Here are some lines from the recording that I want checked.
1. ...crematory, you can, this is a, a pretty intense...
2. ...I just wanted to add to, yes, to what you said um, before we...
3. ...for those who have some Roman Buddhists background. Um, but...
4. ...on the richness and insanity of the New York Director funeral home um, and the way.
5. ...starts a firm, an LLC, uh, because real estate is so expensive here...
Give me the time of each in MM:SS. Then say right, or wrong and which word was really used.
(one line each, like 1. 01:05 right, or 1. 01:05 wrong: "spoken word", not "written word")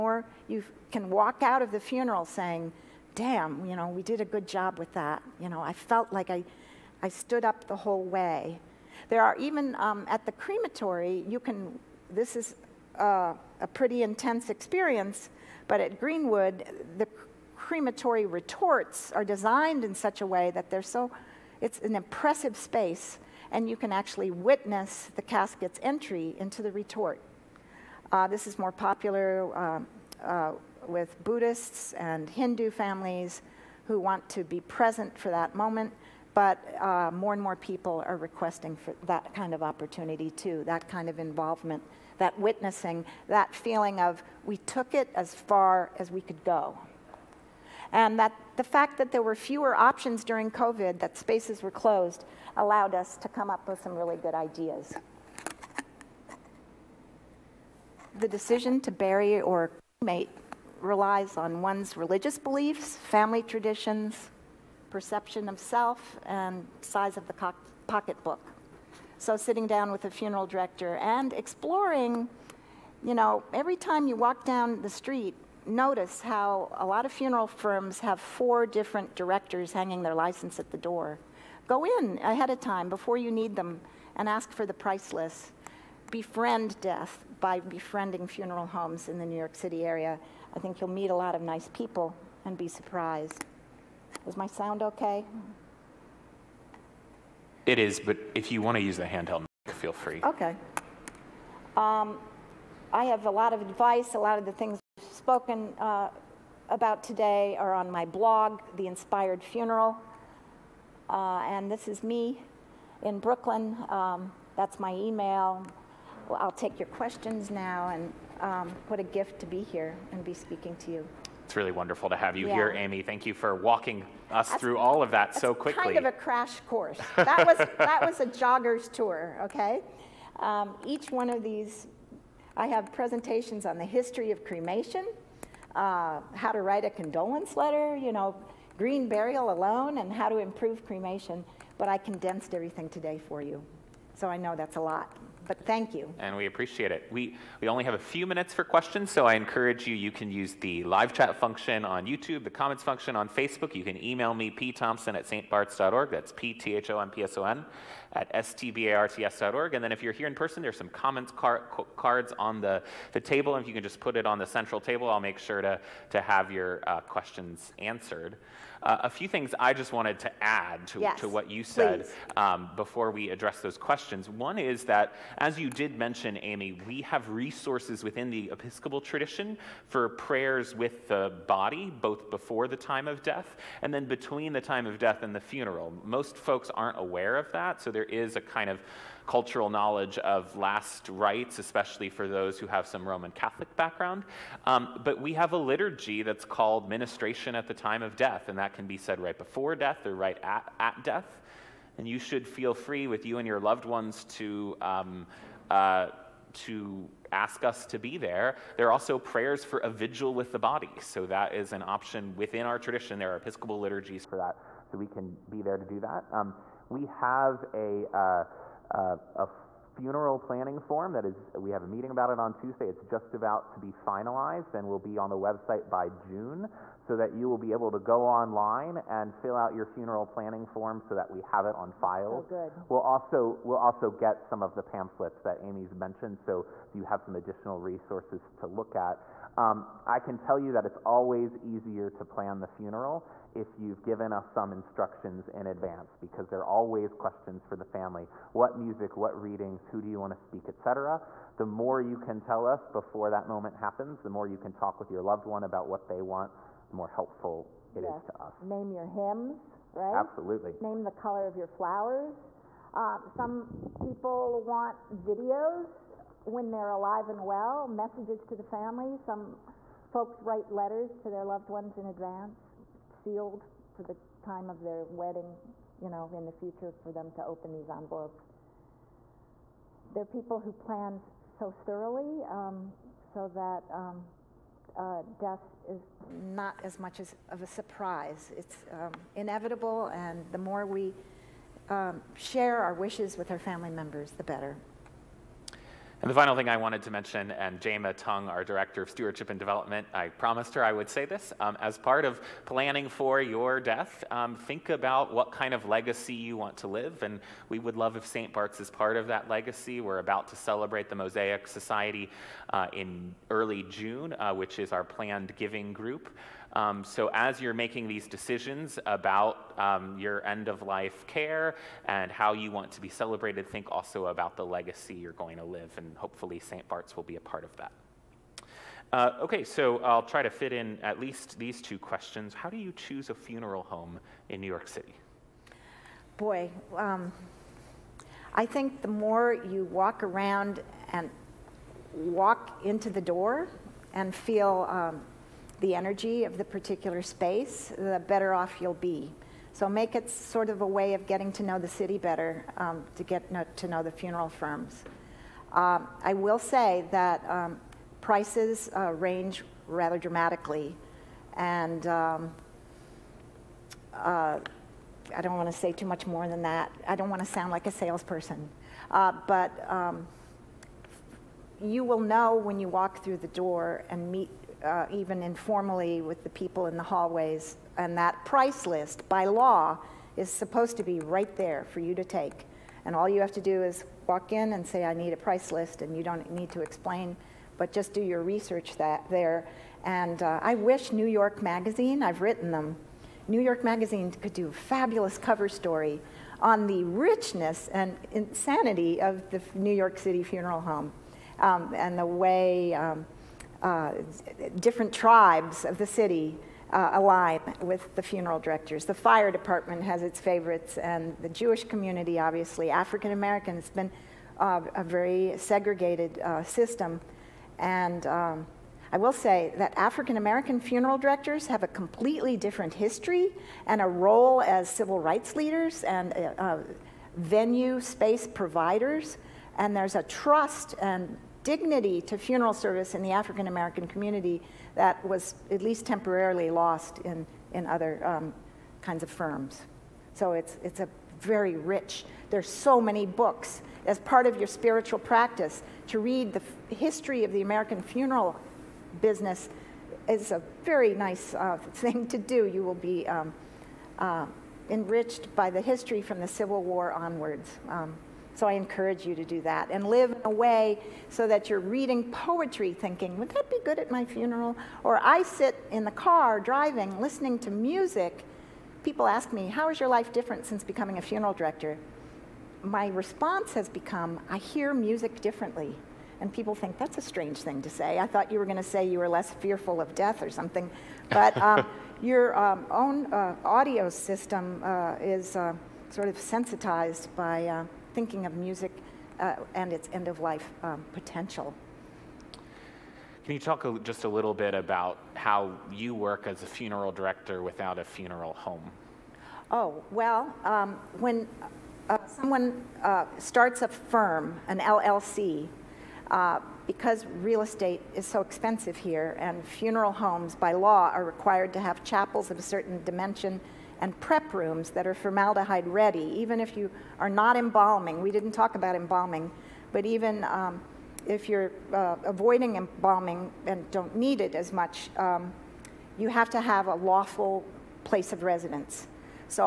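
1. 00:10 right
2. 02:49 right
3. 03:12 wrong: "Catholic", not "Buddhists"
4. 06:36 wrong: "City", not "Director"
5. 08:23 right.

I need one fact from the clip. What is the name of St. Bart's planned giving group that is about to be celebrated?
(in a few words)
Mosaic Society.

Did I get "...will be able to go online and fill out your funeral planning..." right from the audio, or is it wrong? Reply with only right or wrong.
right.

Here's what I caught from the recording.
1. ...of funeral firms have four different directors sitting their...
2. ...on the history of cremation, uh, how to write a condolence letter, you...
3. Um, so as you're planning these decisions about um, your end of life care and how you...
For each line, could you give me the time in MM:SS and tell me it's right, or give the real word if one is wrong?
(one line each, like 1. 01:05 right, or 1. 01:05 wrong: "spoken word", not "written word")
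1. 01:17 wrong: "hanging", not "sitting"
2. 02:13 right
3. 05:16 wrong: "making", not "planning".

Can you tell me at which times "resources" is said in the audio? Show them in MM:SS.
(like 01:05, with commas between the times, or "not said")
02:57, 03:57.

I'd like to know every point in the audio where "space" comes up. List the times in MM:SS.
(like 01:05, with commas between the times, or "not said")
00:22, 00:51, 05:47, 07:07.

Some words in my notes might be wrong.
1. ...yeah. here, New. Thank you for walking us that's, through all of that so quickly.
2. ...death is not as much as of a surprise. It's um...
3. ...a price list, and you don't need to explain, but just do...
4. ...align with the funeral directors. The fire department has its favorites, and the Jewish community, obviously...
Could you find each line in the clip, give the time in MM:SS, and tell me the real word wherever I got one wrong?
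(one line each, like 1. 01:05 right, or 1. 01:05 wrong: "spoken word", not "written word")
1. 02:02 wrong: "Amy", not "New"
2. 04:45 right
3. 06:25 right
4. 06:47 right.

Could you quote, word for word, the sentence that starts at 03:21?
And you should feel free with you and your loved ones to.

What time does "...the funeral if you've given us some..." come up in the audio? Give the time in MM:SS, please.
04:02.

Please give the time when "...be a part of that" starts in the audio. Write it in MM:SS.
05:27.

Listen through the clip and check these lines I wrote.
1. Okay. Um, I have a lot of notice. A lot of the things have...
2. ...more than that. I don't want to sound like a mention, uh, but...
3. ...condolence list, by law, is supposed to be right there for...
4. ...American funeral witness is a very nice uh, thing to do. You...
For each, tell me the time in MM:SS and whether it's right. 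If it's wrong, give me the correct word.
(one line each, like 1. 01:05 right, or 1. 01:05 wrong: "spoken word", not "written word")
1. 01:40 wrong: "advice", not "notice"
2. 06:06 wrong: "salesperson", not "mention"
3. 06:18 wrong: "price", not "condolence"
4. 07:27 wrong: "business", not "witness".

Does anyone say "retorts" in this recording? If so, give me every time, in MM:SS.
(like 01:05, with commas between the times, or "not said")
00:18, 00:26.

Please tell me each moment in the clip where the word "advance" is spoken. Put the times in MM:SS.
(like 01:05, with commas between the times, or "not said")
04:05, 04:32.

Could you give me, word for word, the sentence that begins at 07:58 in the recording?
I thought you were going to say you were less fearful of death or something.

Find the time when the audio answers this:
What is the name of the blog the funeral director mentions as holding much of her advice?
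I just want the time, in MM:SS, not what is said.
01:48.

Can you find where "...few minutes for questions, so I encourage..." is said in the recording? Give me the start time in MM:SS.
02:27.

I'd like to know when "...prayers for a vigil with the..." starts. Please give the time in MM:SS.
03:29.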